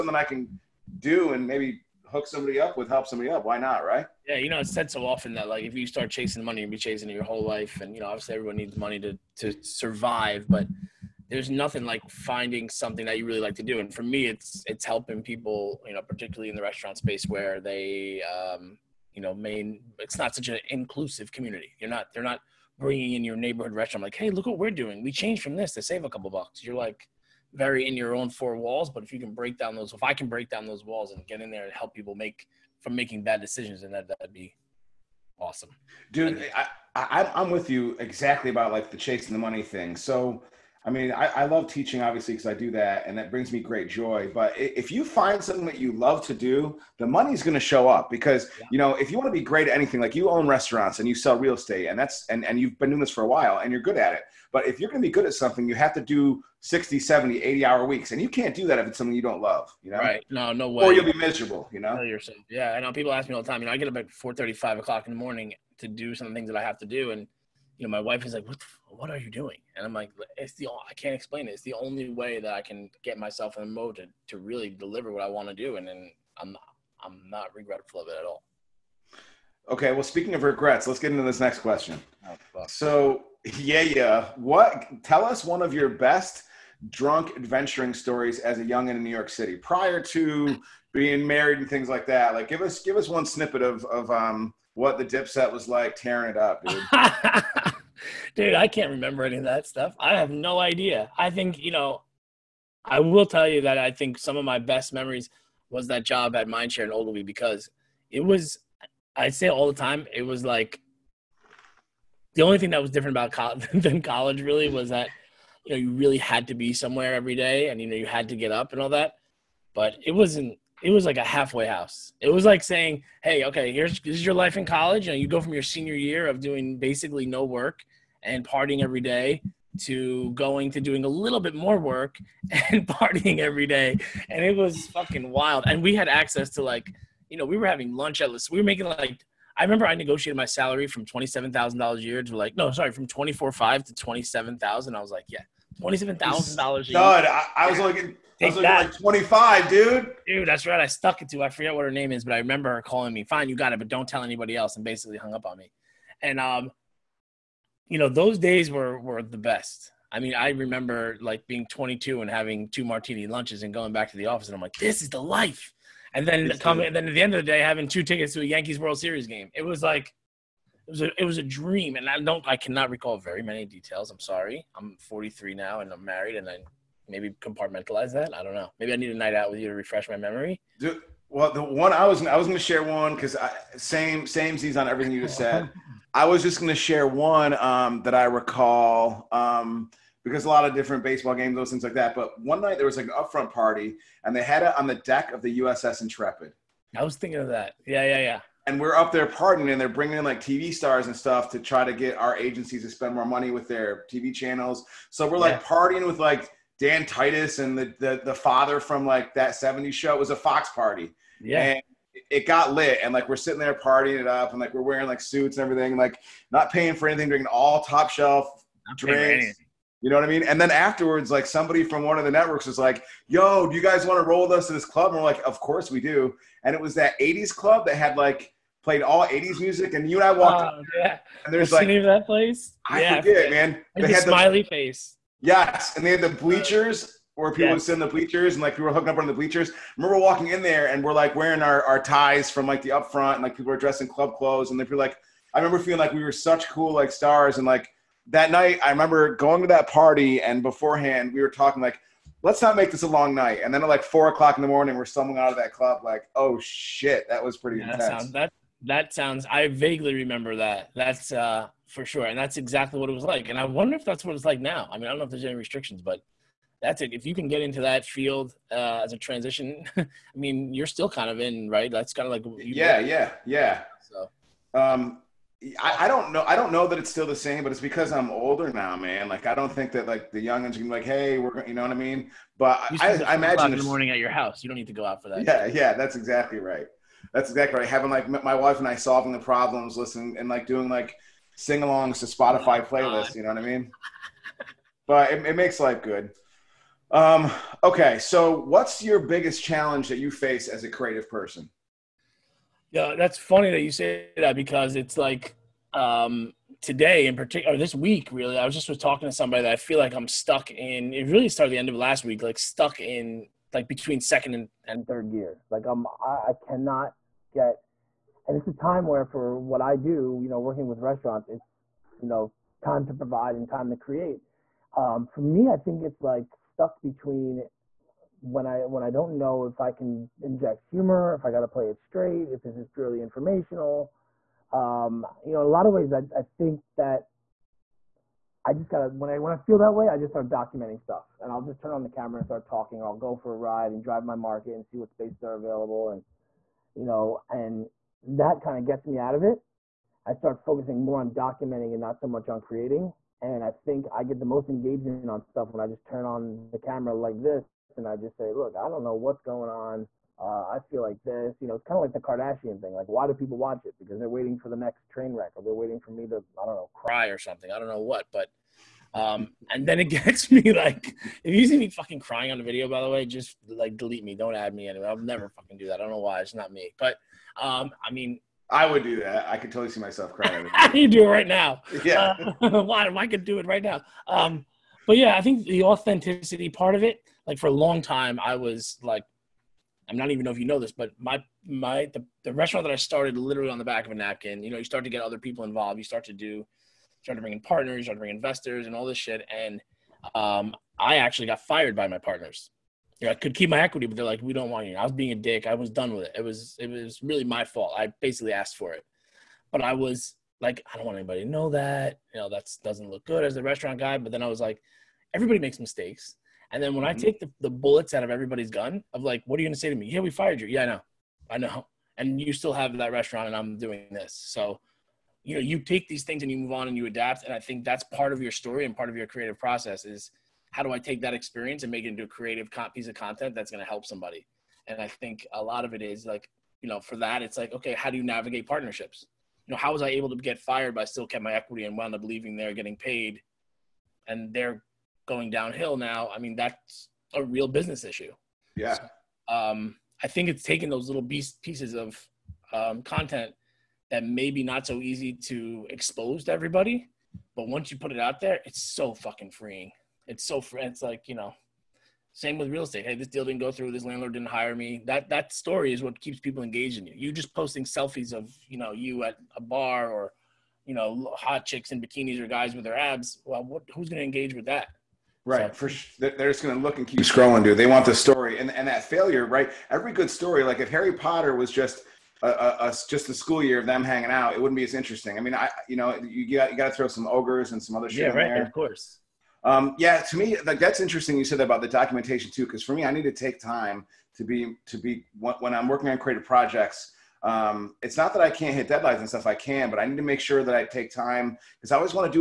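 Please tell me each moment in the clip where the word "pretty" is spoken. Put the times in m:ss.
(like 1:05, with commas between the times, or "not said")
4:17.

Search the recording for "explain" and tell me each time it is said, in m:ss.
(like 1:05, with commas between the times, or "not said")
1:11.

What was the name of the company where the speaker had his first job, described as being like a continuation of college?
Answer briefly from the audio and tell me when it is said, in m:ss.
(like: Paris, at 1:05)
Mindshare, at 1:46.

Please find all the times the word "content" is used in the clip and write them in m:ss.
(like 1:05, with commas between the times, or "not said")
7:13, 7:33.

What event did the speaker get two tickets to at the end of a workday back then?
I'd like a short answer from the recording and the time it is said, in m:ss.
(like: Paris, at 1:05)
Yankees World Series game, at 2:48.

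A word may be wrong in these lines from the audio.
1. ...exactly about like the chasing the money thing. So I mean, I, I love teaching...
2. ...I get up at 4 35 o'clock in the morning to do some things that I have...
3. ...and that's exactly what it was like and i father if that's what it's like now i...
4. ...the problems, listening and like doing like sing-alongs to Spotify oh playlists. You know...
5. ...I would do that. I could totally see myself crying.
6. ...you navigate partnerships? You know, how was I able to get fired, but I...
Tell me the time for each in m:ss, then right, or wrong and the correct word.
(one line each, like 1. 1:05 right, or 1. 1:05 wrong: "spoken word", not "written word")
1. 0:37 right
2. 1:03 right
3. 4:22 wrong: "wonder", not "father"
4. 4:49 right
5. 6:18 right
6. 7:18 right.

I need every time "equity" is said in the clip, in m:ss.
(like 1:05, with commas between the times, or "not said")
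6:43, 7:21.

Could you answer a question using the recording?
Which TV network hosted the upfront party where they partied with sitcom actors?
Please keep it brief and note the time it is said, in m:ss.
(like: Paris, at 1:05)
Fox, at 3:30.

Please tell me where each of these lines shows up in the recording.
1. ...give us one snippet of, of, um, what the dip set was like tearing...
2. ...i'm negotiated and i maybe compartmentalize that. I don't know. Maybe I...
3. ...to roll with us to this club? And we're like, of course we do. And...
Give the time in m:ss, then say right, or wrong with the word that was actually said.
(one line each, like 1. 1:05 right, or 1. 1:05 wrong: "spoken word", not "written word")
1. 1:32 right
2. 2:55 wrong: "married", not "negotiated"
3. 3:44 right.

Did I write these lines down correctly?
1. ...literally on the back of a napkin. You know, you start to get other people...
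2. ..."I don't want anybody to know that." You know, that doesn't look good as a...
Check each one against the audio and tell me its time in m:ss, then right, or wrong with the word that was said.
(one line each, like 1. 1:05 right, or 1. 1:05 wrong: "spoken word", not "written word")
1. 6:33 right
2. 6:50 right.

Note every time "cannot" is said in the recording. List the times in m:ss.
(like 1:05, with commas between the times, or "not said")
2:52, 5:16.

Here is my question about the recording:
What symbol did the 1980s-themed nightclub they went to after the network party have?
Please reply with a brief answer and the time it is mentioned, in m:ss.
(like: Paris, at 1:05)
smiley face, at 3:54.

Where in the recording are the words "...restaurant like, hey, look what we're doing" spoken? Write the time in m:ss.
0:23.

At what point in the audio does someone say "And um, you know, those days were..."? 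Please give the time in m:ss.
2:36.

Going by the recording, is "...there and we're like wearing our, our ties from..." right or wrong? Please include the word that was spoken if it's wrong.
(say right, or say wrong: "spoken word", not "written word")
right.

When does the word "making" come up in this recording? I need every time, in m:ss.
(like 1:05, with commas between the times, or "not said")
0:32, 2:18.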